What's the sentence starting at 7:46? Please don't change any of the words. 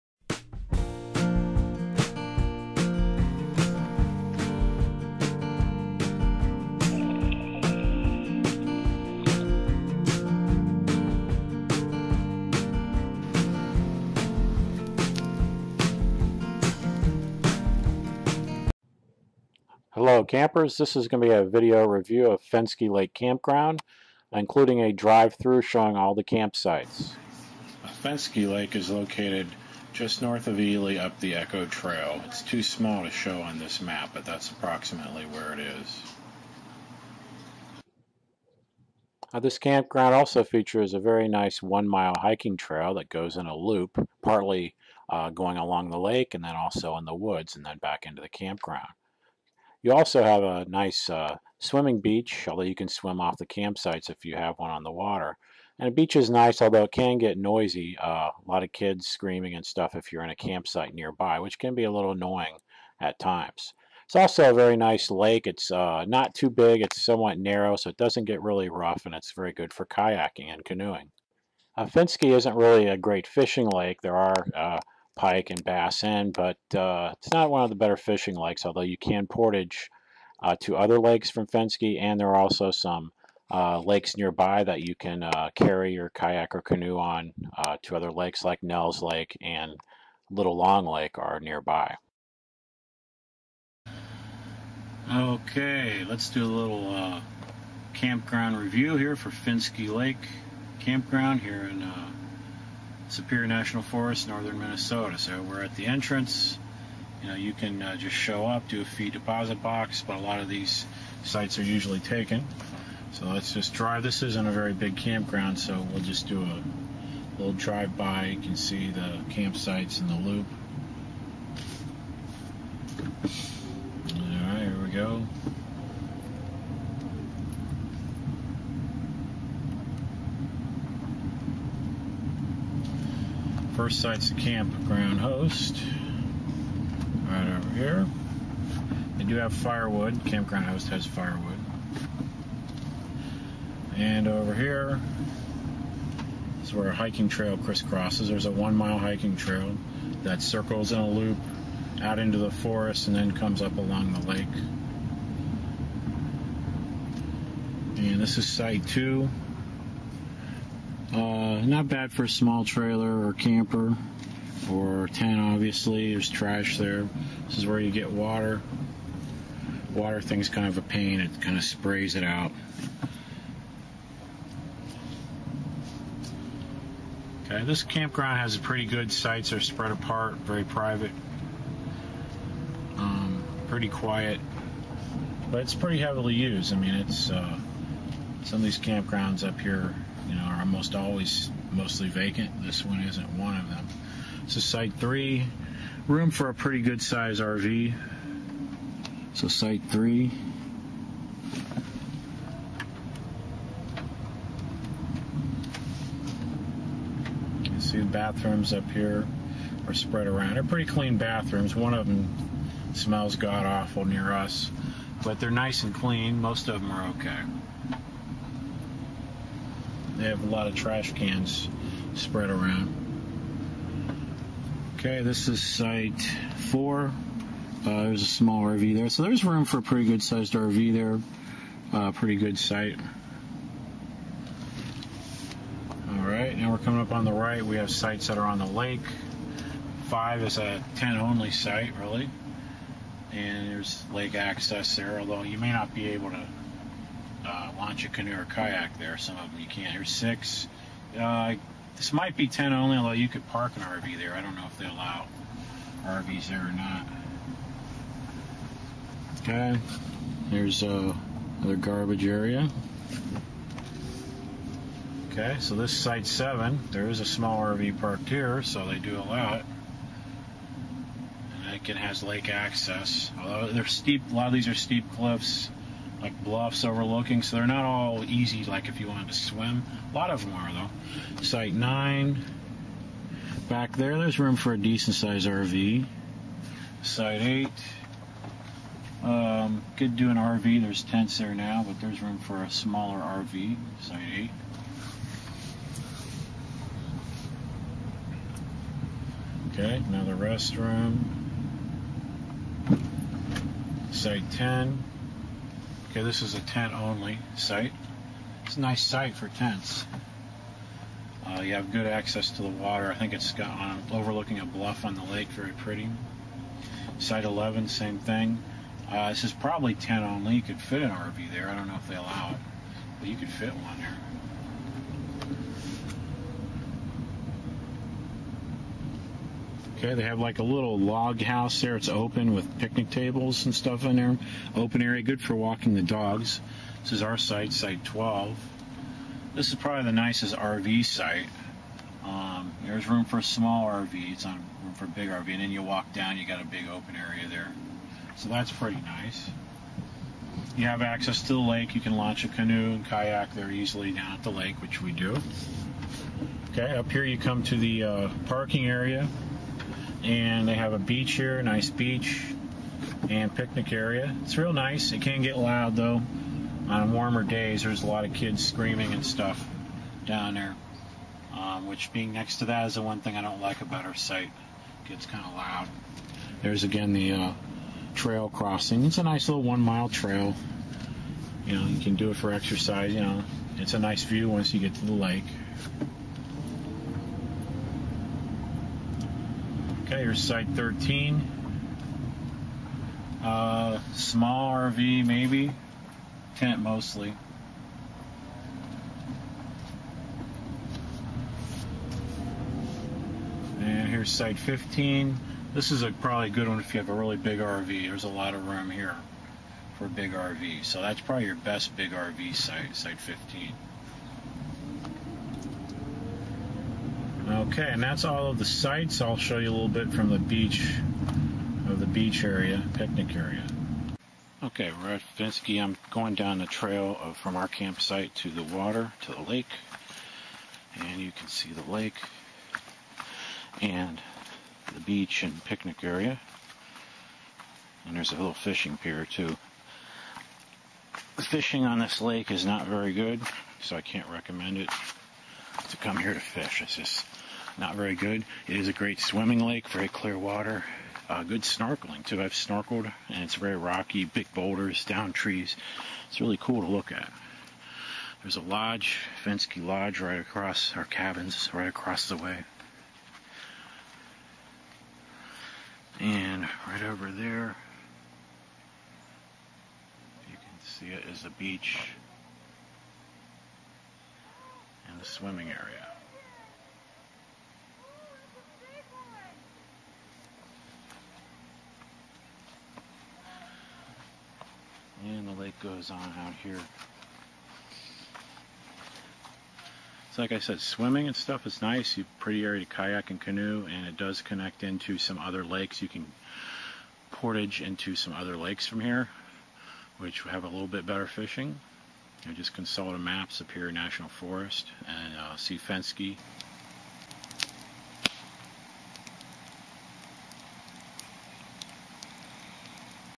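And right over there, you can see it is the beach and the swimming area.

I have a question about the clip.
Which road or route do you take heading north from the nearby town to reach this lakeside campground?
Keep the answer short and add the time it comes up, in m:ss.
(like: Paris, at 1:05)
Echo Trail, at 0:31.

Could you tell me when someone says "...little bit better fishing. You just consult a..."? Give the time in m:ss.
8:20.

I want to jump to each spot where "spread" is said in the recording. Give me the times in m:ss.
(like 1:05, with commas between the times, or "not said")
2:59, 3:29, 3:42.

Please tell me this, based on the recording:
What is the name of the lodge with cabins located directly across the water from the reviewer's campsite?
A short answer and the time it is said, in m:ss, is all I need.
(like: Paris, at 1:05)
Fenske Lodge, at 7:39.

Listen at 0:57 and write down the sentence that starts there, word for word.
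Uh, a lot of kids screaming and stuff if you're in a campsite nearby, which can be a little annoying at times.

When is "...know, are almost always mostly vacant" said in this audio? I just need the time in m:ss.
3:10.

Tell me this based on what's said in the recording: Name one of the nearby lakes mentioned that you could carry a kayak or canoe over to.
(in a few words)
Nels Lake.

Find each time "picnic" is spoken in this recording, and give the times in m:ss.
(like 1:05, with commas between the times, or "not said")
5:32, 6:03, 7:02, 7:15.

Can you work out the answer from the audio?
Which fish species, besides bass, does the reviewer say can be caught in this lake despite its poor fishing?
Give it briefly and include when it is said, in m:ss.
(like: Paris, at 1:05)
Pike, at 1:15.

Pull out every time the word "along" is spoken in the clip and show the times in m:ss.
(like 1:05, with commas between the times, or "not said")
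0:45, 2:33.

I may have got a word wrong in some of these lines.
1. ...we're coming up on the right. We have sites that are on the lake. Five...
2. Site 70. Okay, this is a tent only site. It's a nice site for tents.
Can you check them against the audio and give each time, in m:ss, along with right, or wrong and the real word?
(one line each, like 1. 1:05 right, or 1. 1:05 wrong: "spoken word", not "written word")
1. 3:56 right
2. 5:04 wrong: "10", not "70".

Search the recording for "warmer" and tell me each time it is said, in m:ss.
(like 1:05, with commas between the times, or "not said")
6:07.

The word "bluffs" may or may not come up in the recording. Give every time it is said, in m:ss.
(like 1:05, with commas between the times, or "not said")
4:36, 5:14.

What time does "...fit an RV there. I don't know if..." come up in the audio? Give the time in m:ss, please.
5:20.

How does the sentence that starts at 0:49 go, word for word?
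You also have a nice uh, swimming beach, although you can swim off the campsites if you have one on the water.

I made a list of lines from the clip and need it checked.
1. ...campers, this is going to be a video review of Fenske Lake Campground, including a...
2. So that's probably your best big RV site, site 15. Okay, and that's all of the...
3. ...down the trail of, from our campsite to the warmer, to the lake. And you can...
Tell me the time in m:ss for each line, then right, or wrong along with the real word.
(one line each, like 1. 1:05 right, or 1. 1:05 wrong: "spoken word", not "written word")
1. 0:20 right
2. 6:50 right
3. 7:06 wrong: "water", not "warmer".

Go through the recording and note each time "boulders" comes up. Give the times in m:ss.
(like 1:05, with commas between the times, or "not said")
7:34.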